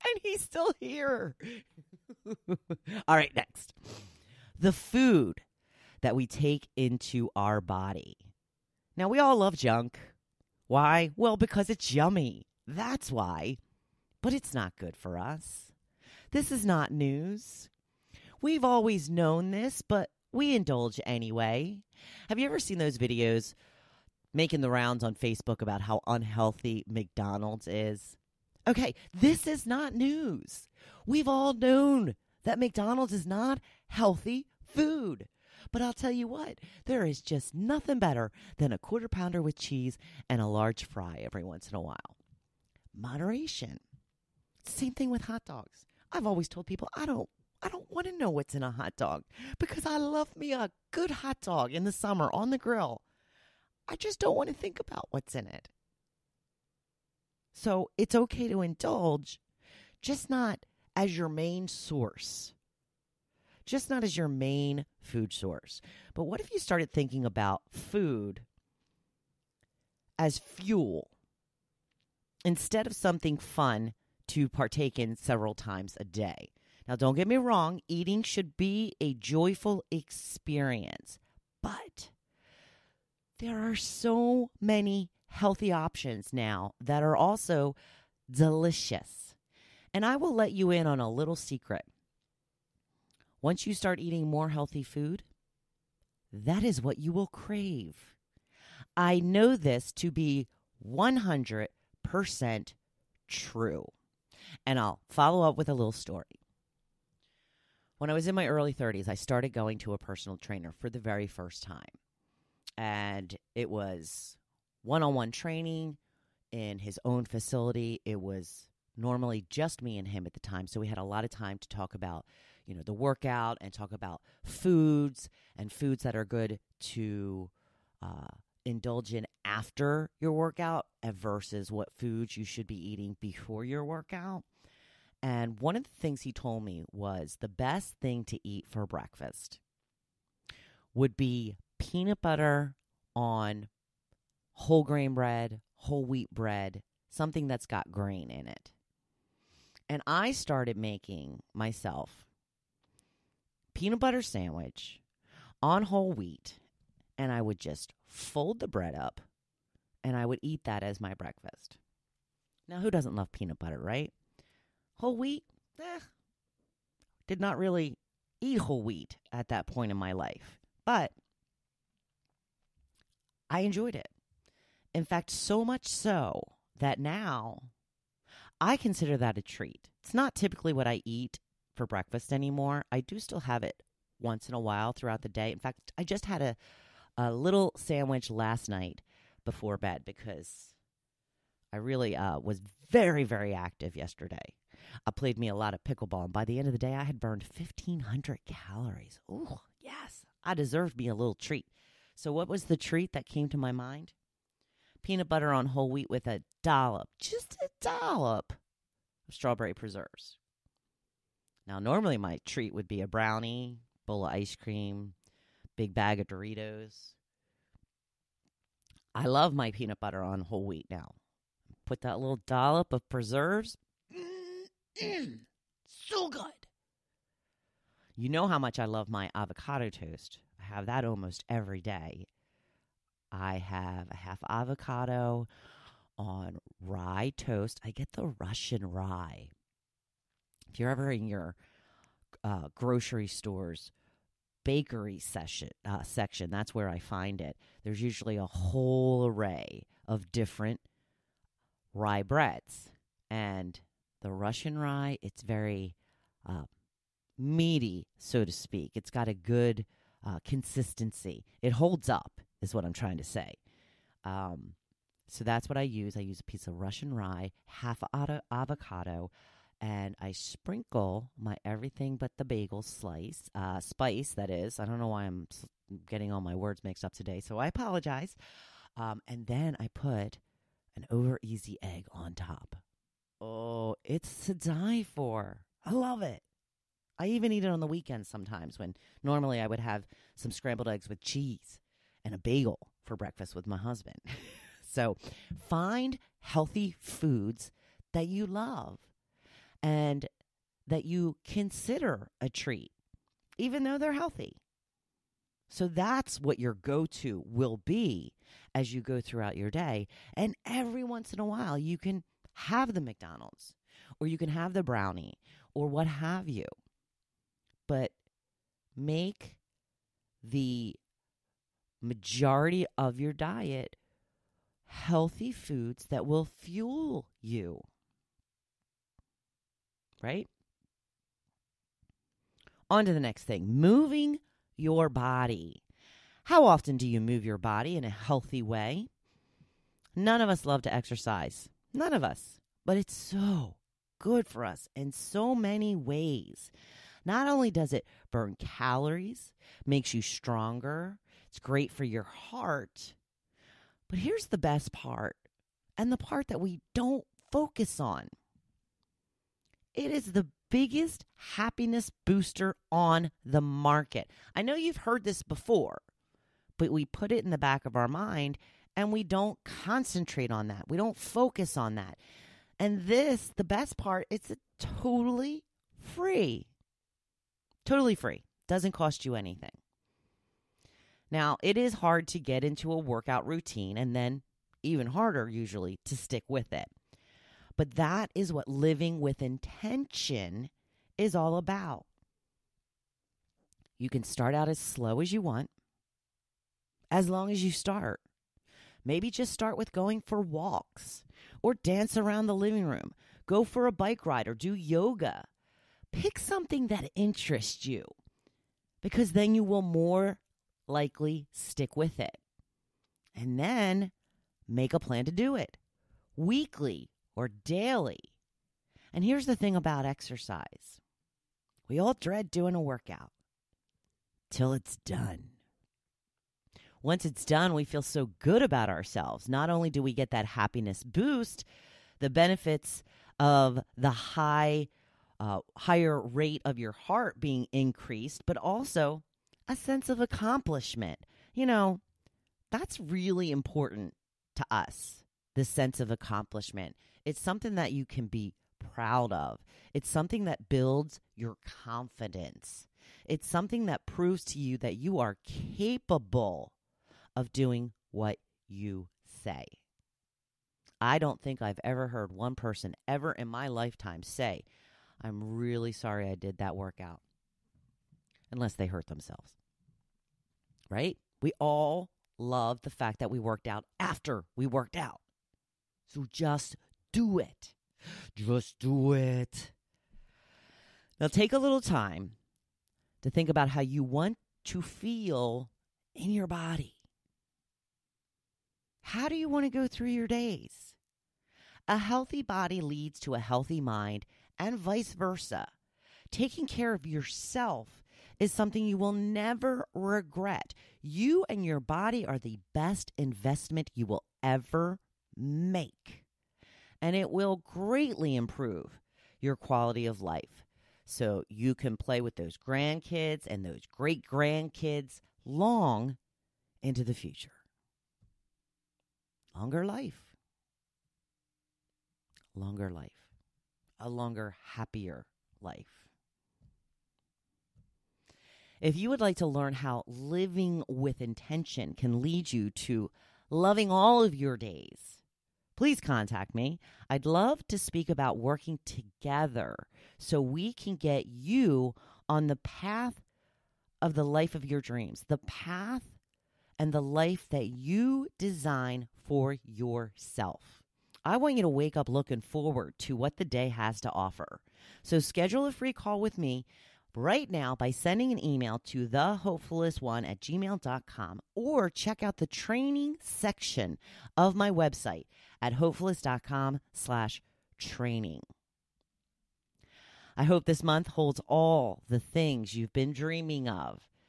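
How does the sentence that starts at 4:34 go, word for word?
I don't know why I'm getting all my words mixed up today, so I apologize.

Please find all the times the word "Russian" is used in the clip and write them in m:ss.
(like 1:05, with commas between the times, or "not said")
3:58, 4:14, 4:26.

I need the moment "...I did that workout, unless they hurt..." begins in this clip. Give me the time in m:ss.
7:46.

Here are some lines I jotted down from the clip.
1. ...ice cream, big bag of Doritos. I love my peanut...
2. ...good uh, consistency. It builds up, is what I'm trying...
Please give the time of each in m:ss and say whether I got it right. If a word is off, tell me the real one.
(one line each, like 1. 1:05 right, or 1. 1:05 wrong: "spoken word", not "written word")
1. 3:34 right
2. 4:19 wrong: "holds", not "builds".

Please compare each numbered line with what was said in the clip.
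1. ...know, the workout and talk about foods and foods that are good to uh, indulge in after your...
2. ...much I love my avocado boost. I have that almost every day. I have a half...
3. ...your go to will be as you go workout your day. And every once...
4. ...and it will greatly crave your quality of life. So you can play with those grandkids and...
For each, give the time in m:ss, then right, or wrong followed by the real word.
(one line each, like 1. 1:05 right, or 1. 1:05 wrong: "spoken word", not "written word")
1. 2:02 right
2. 3:48 wrong: "toast", not "boost"
3. 5:06 wrong: "throughout", not "workout"
4. 8:26 wrong: "improve", not "crave".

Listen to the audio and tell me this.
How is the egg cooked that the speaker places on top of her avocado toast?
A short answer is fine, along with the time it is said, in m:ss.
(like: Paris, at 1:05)
Over easy, at 4:41.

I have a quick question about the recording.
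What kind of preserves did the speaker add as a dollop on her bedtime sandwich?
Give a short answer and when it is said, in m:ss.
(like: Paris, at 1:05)
Strawberry, at 3:29.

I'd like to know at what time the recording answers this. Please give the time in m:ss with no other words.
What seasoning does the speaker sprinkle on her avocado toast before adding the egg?
4:31.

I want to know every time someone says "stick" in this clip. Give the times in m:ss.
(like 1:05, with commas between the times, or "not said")
6:26, 6:51.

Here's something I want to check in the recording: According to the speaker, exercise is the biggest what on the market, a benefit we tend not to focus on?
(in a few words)
Happiness booster.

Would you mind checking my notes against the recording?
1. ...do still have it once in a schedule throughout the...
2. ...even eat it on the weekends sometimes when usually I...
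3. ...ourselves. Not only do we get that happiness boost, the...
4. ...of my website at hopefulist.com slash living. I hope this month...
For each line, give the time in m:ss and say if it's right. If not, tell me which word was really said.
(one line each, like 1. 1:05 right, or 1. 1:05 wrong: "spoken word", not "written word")
1. 3:03 wrong: "while", not "schedule"
2. 4:47 wrong: "normally", not "usually"
3. 7:08 right
4. 9:24 wrong: "training", not "living".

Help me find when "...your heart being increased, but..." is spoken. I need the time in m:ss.
7:16.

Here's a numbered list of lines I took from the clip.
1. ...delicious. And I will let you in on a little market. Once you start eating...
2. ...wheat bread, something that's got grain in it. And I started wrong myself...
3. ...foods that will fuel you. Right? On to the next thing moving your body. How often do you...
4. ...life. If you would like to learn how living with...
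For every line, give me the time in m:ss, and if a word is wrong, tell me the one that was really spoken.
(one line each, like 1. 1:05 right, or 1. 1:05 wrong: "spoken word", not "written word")
1. 1:28 wrong: "secret", not "market"
2. 2:26 wrong: "making", not "wrong"
3. 5:25 right
4. 8:45 right.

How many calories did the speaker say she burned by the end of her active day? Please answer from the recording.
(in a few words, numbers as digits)
1,500.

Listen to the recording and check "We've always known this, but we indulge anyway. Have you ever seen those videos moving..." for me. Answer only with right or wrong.
wrong.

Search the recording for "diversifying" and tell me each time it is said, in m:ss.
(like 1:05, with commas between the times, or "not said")
not said.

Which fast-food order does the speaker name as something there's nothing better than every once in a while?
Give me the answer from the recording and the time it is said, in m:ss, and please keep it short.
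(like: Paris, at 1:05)
Quarter pounder with cheese, at 0:38.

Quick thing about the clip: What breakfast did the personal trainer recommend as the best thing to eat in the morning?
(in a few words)
Peanut butter on whole grain bread.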